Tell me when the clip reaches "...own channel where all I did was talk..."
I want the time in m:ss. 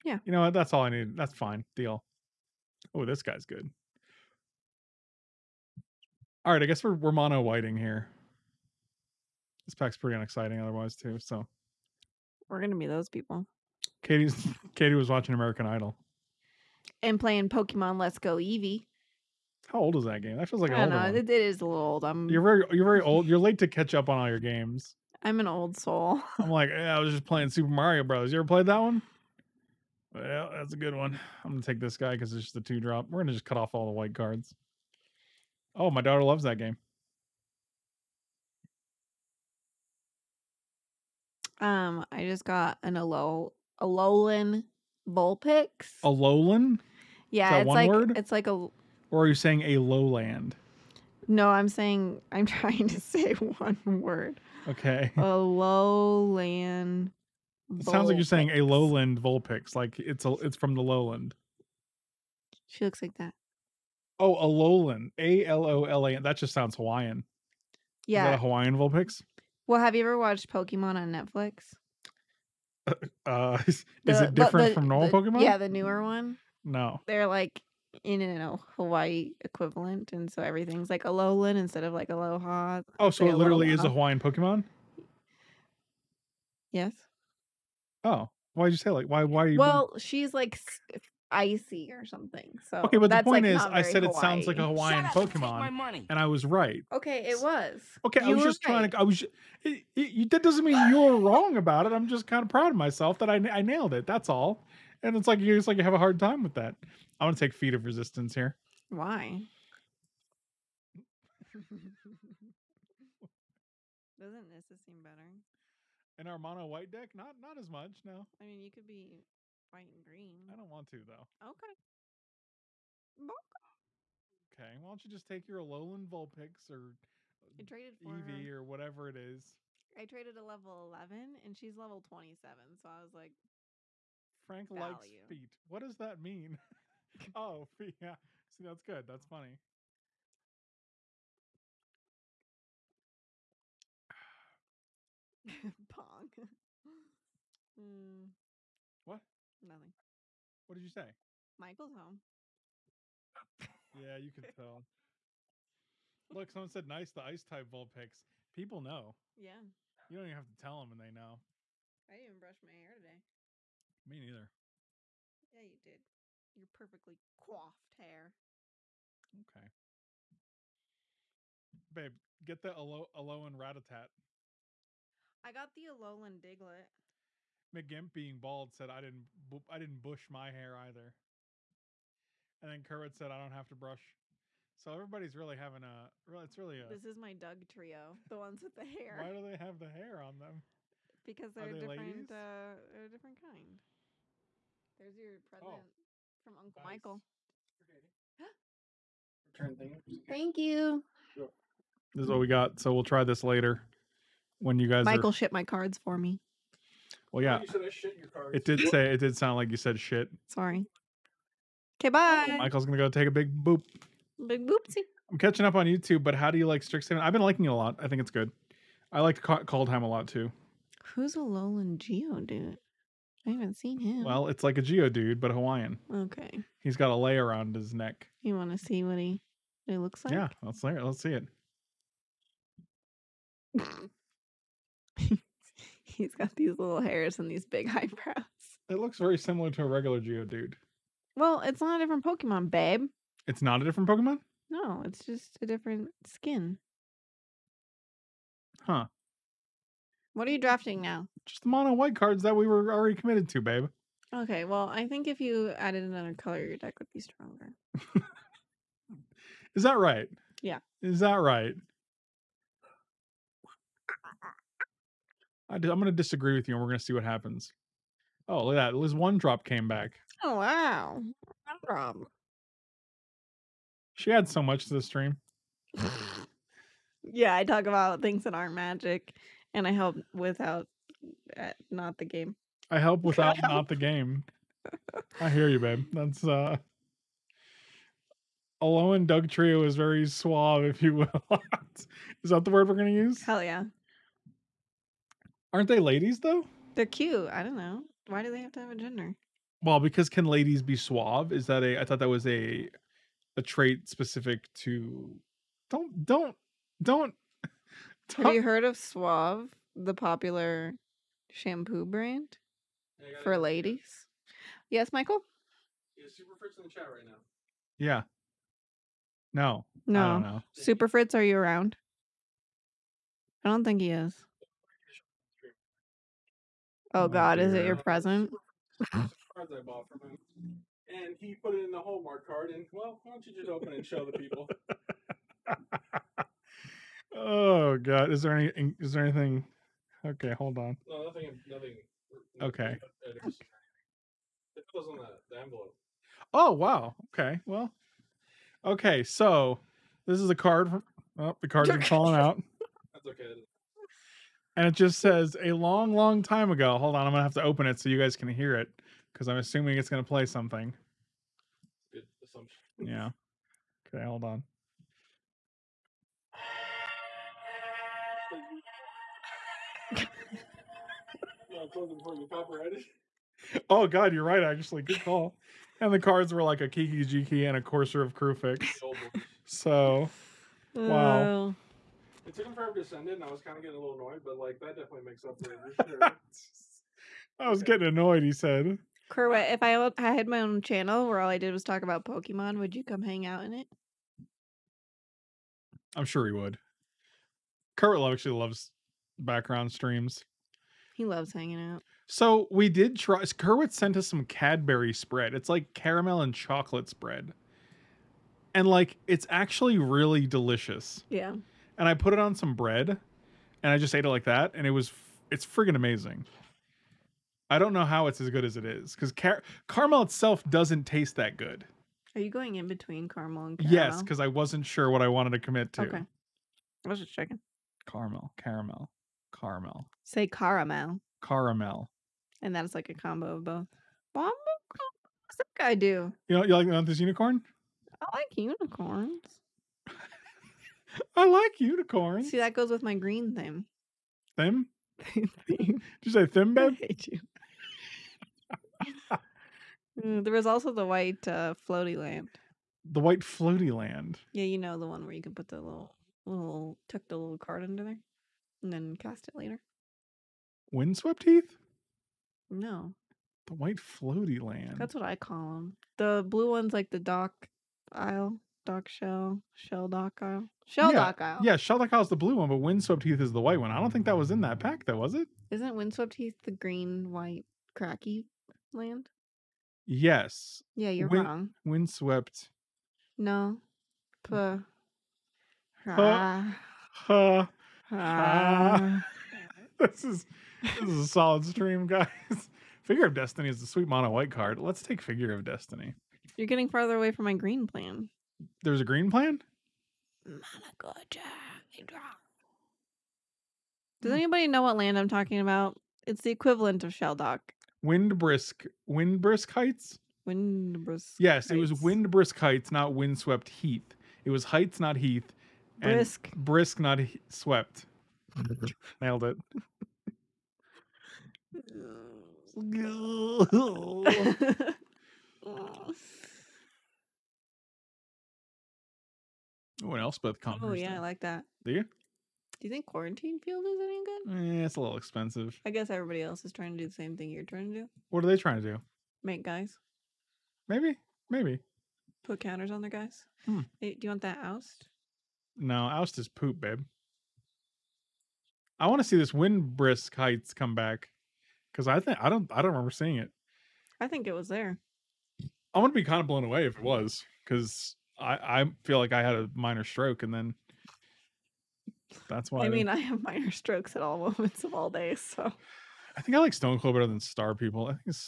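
6:30.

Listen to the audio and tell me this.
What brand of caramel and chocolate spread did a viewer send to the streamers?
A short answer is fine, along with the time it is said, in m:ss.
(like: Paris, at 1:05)
Cadbury, at 6:44.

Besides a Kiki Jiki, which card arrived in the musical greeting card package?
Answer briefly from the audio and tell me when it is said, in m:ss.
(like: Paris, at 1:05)
Courser of Kruphix, at 6:17.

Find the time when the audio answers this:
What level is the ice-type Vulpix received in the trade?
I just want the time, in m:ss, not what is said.
2:11.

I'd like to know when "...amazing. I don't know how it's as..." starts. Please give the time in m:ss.
6:55.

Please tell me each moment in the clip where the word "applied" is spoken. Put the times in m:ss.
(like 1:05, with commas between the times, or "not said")
not said.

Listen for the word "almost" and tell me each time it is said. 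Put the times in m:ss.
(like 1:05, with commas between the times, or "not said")
not said.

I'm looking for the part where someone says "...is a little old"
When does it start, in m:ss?
0:21.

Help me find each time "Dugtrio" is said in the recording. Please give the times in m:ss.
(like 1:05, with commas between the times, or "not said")
3:07, 4:49.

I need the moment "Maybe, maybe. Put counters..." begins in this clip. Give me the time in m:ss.
9:00.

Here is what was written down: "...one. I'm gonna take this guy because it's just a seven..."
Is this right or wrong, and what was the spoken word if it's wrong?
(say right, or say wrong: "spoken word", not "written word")
wrong: "two", not "seven".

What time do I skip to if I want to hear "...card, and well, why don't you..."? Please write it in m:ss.
5:32.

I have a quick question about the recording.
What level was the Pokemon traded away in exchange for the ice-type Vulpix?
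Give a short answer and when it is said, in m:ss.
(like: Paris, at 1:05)
11, at 2:10.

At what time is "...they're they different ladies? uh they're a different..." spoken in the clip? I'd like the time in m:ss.
3:11.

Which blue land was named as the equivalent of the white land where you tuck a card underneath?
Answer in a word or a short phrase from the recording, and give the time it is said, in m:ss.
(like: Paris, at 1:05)
Shelldock Isle, at 7:51.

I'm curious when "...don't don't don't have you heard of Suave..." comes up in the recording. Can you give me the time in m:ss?
5:05.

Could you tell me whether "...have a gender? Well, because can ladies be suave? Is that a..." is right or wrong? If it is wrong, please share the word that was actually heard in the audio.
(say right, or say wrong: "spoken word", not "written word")
right.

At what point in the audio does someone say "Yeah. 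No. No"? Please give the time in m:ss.
5:17.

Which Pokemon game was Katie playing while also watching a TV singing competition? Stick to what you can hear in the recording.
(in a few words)
Pokemon Let's Go Eevee.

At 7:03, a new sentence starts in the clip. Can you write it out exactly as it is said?
Yes, because I wasn't sure what I wanted to commit to.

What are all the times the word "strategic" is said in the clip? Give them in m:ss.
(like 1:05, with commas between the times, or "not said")
not said.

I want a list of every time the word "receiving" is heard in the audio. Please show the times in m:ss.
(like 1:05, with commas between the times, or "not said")
not said.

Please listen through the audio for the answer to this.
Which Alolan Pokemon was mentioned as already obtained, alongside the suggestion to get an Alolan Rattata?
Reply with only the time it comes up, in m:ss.
2:55.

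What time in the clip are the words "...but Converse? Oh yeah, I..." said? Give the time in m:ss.
8:50.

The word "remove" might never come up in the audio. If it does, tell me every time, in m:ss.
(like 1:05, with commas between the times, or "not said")
not said.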